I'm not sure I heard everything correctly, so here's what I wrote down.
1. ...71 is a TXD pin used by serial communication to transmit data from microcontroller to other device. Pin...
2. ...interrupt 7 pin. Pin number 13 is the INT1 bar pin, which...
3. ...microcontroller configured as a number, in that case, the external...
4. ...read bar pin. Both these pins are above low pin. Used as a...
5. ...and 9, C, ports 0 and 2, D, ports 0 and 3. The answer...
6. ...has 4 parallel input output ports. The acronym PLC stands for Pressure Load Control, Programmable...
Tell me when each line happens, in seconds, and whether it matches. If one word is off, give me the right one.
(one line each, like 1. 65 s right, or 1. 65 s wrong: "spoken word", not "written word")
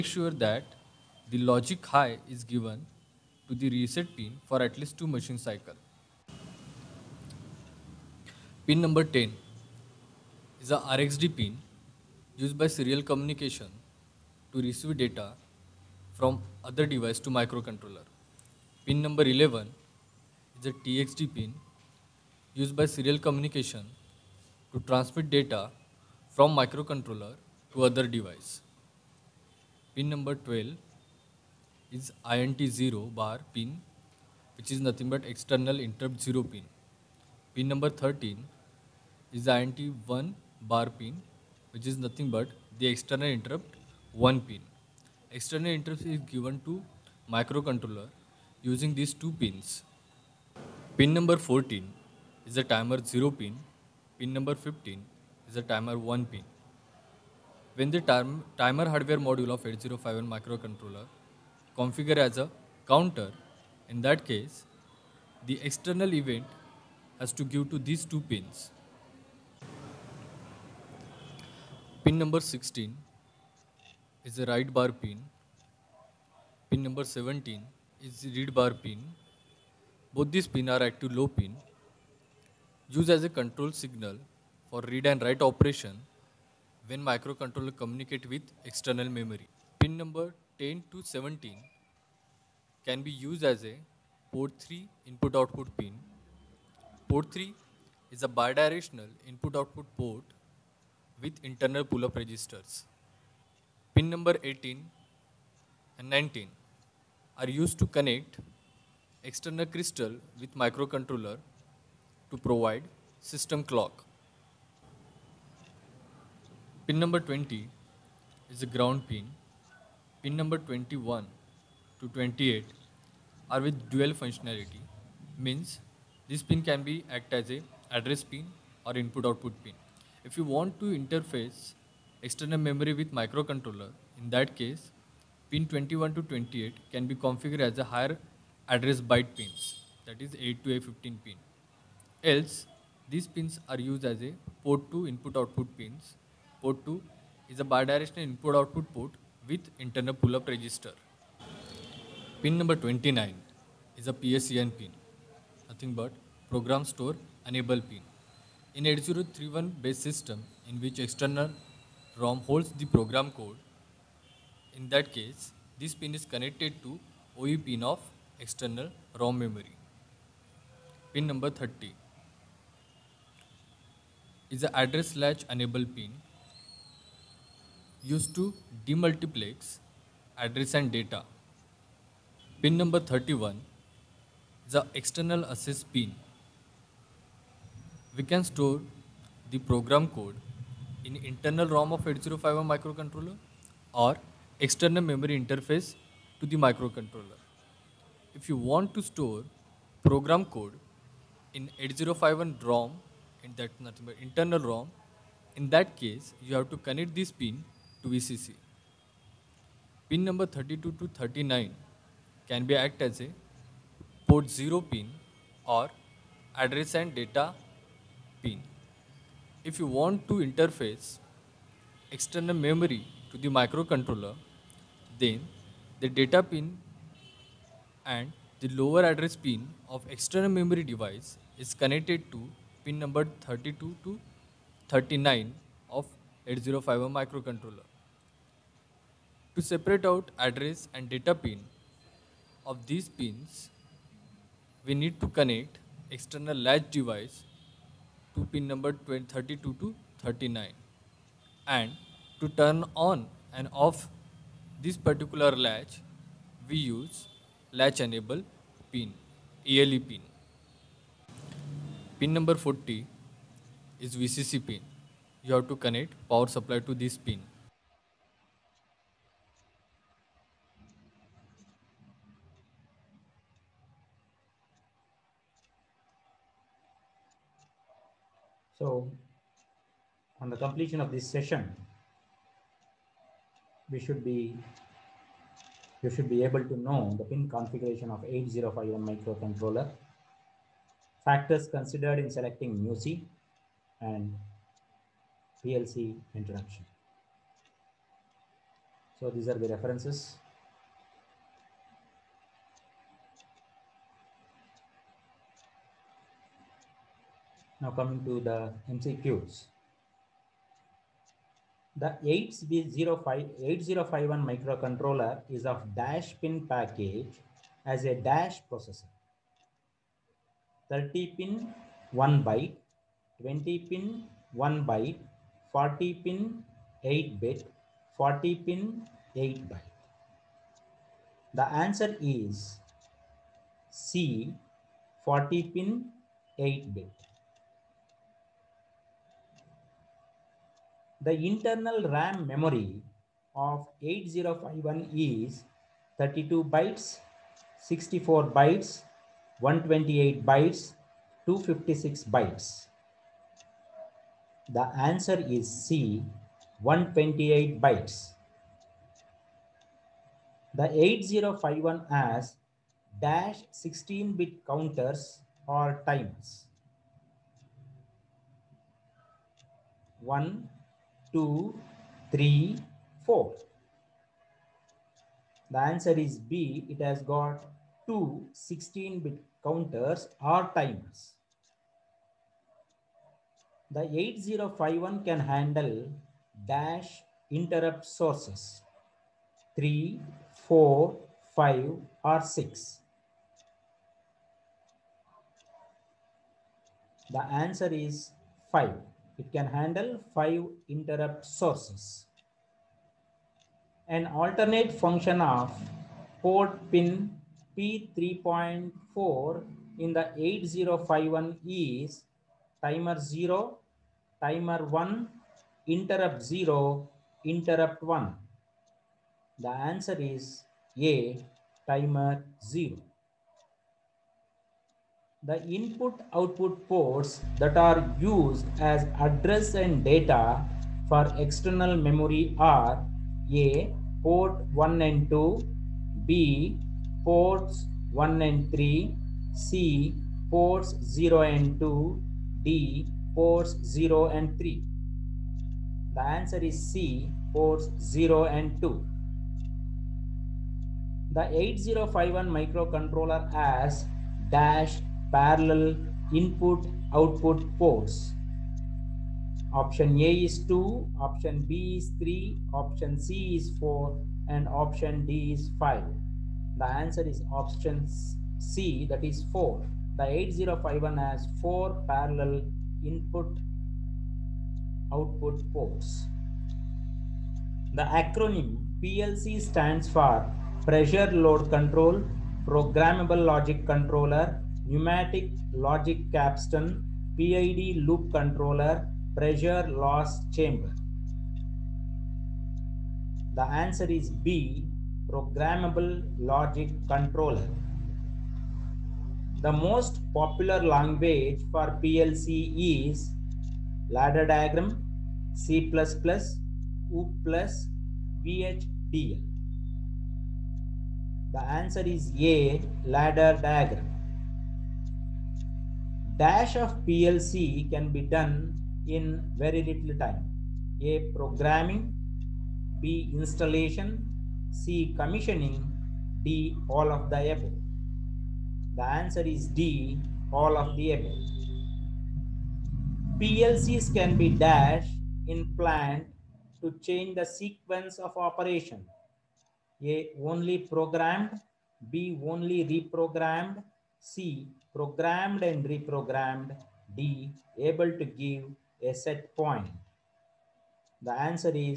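1. 19 s wrong: "11", not "71"
2. 35 s wrong: "0", not "7"
3. 60 s wrong: "counter", not "number"
4. 78 s wrong: "active", not "above"
5. 438 s wrong: "3", not "9"
6. 471 s right.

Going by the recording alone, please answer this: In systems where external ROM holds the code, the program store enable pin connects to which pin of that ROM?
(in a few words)
OE pin.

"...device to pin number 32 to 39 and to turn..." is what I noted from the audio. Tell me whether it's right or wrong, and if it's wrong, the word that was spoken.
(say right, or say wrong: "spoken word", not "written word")
right.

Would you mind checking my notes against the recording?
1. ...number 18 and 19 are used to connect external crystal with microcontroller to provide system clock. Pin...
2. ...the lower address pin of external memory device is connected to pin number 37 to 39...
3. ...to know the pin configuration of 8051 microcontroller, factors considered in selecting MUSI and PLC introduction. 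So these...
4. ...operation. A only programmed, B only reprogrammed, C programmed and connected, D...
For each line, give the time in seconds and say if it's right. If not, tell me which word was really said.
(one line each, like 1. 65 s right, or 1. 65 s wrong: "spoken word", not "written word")
1. 104 s right
2. 228 s wrong: "32", not "37"
3. 286 s right
4. 538 s wrong: "reprogrammed", not "connected".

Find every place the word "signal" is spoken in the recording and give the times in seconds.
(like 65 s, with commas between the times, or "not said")
83 s.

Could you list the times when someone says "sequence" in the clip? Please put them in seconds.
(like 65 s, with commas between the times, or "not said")
537 s.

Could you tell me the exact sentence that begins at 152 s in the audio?
Pin number 29 is a PSEN pin, nothing but program store enable pin.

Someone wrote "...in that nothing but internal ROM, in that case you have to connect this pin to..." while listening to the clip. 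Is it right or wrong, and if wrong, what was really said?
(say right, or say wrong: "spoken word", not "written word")
right.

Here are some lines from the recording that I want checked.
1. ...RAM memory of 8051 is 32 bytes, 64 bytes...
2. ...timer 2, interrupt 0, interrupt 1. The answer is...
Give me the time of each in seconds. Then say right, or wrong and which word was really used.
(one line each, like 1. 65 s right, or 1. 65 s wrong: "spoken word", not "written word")
1. 342 s right
2. 414 s wrong: "1", not "2".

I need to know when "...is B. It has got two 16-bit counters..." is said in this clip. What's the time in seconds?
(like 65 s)
376 s.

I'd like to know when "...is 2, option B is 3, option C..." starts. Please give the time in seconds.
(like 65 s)
460 s.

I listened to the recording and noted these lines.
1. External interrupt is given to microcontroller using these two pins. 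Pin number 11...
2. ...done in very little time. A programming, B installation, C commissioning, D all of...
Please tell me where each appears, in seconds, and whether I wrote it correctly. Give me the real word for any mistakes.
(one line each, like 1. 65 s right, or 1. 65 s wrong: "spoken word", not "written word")
1. 45 s wrong: "14", not "11"
2. 518 s right.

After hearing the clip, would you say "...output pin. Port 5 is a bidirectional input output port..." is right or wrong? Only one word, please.
wrong.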